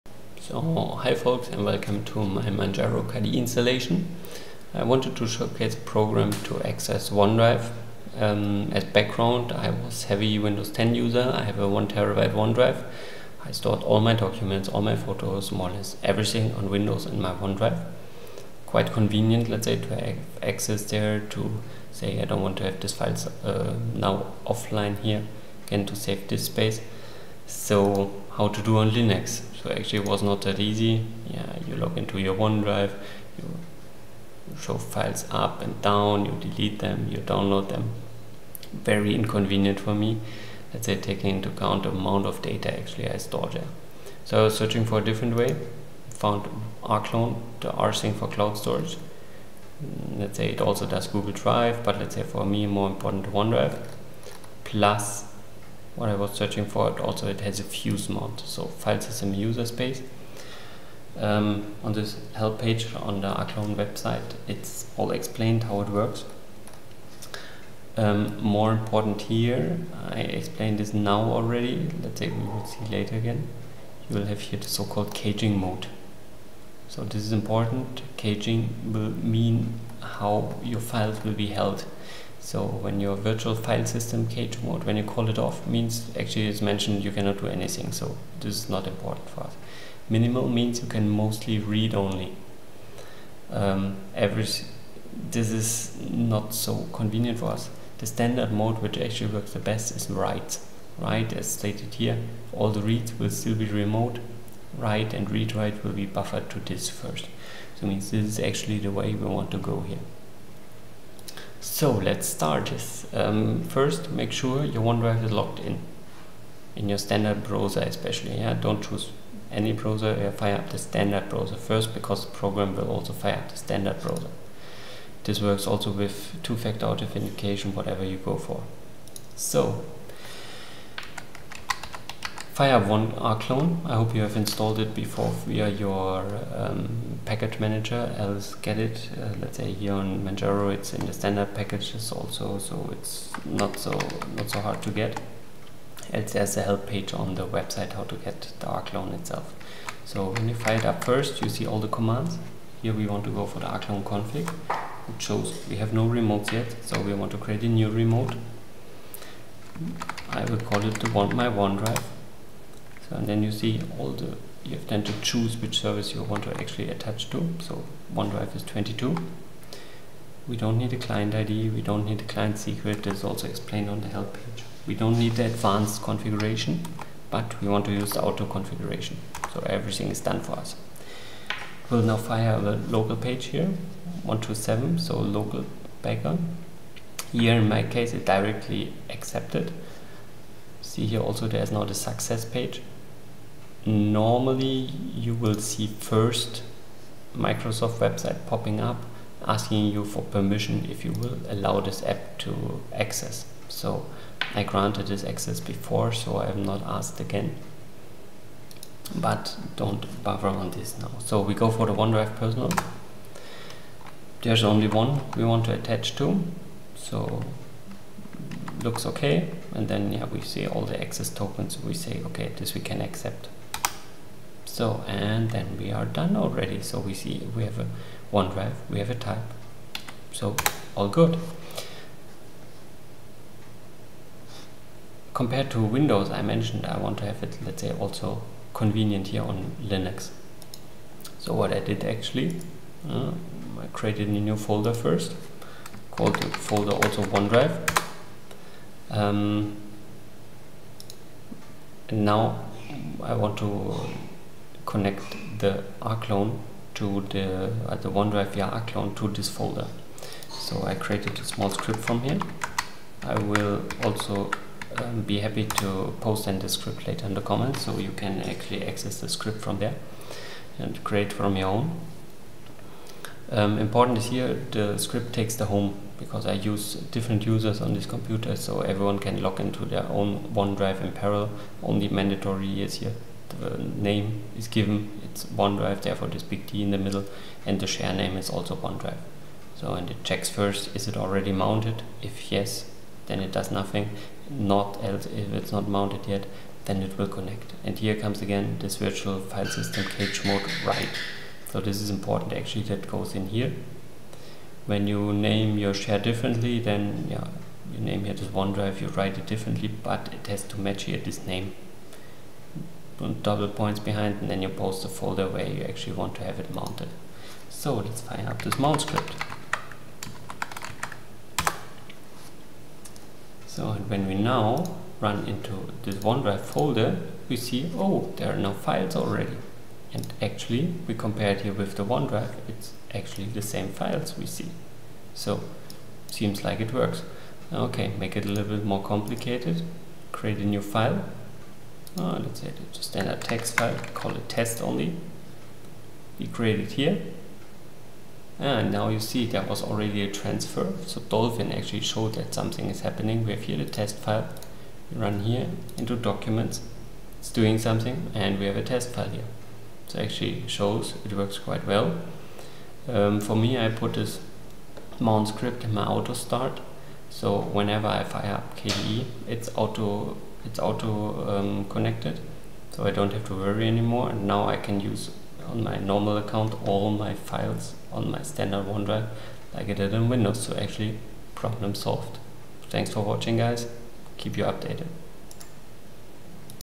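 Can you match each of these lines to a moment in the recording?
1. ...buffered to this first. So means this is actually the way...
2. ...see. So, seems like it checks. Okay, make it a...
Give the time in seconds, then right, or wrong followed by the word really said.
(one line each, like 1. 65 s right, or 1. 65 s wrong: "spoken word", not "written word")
1. 106 s right
2. 334 s wrong: "works", not "checks".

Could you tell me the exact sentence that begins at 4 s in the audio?
I wanted to showcase a program to access OneDrive.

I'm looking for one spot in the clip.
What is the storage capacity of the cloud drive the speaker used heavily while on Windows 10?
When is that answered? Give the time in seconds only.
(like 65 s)
11 s.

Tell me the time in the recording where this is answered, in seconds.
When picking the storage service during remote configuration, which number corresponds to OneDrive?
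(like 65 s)
168 s.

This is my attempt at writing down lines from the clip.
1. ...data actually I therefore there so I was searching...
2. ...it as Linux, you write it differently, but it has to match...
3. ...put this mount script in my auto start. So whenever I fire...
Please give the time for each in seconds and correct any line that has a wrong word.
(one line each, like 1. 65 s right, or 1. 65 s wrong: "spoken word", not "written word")
1. 42 s wrong: "store", not "therefore"
2. 308 s wrong: "OneDrive", not "Linux"
3. 363 s right.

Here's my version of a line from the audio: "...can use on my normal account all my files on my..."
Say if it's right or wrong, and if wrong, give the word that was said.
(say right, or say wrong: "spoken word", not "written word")
right.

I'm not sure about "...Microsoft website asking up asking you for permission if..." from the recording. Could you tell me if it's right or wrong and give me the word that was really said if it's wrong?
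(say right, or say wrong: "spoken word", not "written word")
wrong: "popping", not "asking".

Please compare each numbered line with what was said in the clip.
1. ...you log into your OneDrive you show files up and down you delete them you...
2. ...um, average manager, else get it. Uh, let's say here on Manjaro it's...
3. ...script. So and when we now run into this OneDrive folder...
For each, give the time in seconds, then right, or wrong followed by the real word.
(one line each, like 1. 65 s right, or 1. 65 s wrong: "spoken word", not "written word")
1. 31 s right
2. 136 s wrong: "package", not "average"
3. 319 s right.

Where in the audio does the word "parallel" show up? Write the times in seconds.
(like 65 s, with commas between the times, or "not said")
281 s.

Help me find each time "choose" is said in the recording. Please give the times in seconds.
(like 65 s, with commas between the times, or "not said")
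118 s, 165 s.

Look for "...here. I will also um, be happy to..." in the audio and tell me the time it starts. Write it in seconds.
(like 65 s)
262 s.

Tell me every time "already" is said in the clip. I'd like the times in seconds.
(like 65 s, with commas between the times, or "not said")
71 s, 226 s, 291 s, 329 s, 349 s.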